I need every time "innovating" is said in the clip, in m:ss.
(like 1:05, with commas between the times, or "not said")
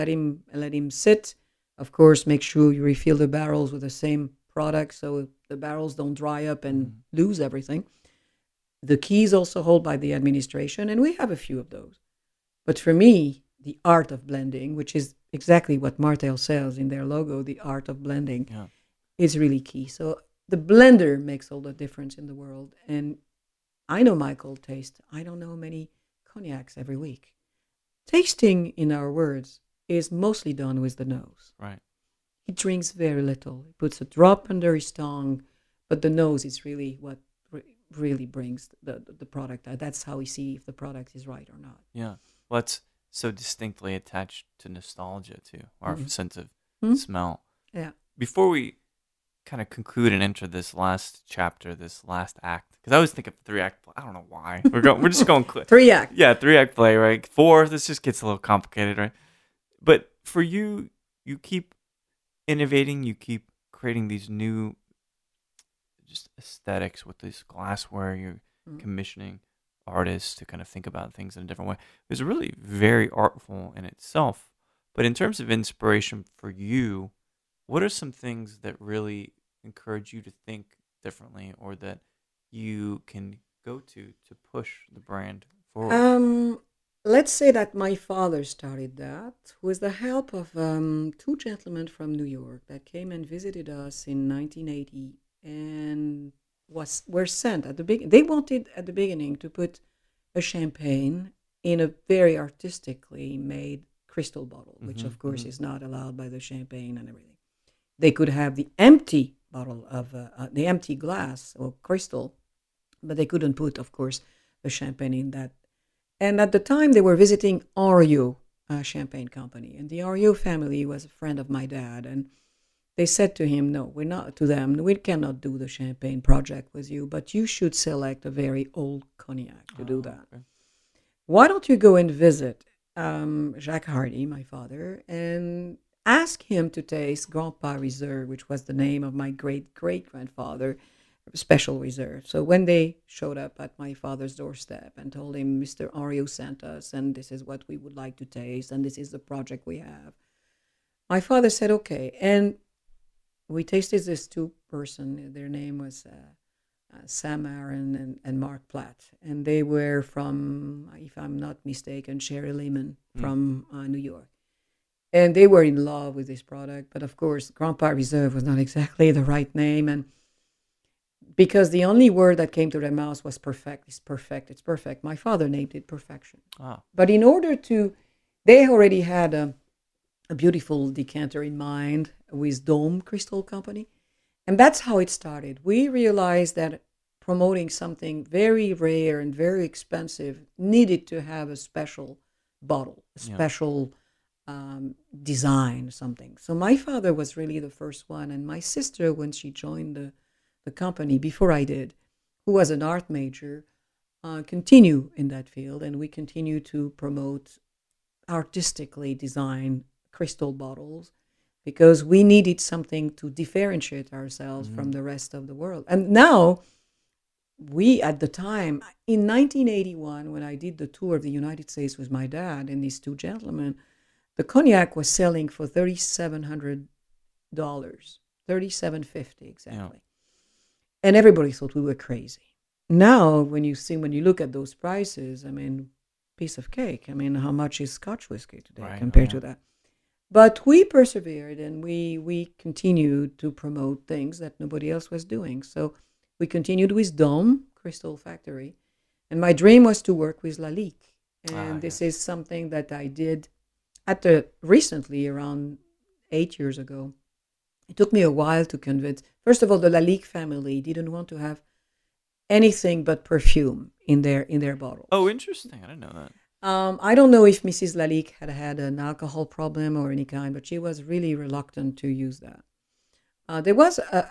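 1:02.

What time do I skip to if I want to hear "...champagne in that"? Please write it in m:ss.
1:54.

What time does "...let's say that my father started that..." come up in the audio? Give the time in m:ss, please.
1:27.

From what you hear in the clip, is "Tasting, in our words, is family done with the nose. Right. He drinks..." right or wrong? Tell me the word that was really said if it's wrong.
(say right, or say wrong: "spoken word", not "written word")
wrong: "mostly", not "family".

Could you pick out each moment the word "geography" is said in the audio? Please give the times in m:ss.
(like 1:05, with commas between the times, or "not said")
not said.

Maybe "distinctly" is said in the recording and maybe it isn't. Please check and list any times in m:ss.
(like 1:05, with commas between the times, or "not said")
0:43.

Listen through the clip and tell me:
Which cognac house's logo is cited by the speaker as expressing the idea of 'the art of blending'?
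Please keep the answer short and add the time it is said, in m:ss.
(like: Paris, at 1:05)
Martell, at 0:15.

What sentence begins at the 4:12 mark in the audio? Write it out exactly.
is something that I did at the recently around eight years ago.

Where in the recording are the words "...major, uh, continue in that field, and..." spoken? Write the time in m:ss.
3:23.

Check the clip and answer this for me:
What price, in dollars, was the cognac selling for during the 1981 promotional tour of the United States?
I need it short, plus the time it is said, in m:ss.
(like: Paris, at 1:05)
$3,750, at 3:48.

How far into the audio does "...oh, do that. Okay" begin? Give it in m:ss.
2:09.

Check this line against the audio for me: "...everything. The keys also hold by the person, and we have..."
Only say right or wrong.
wrong.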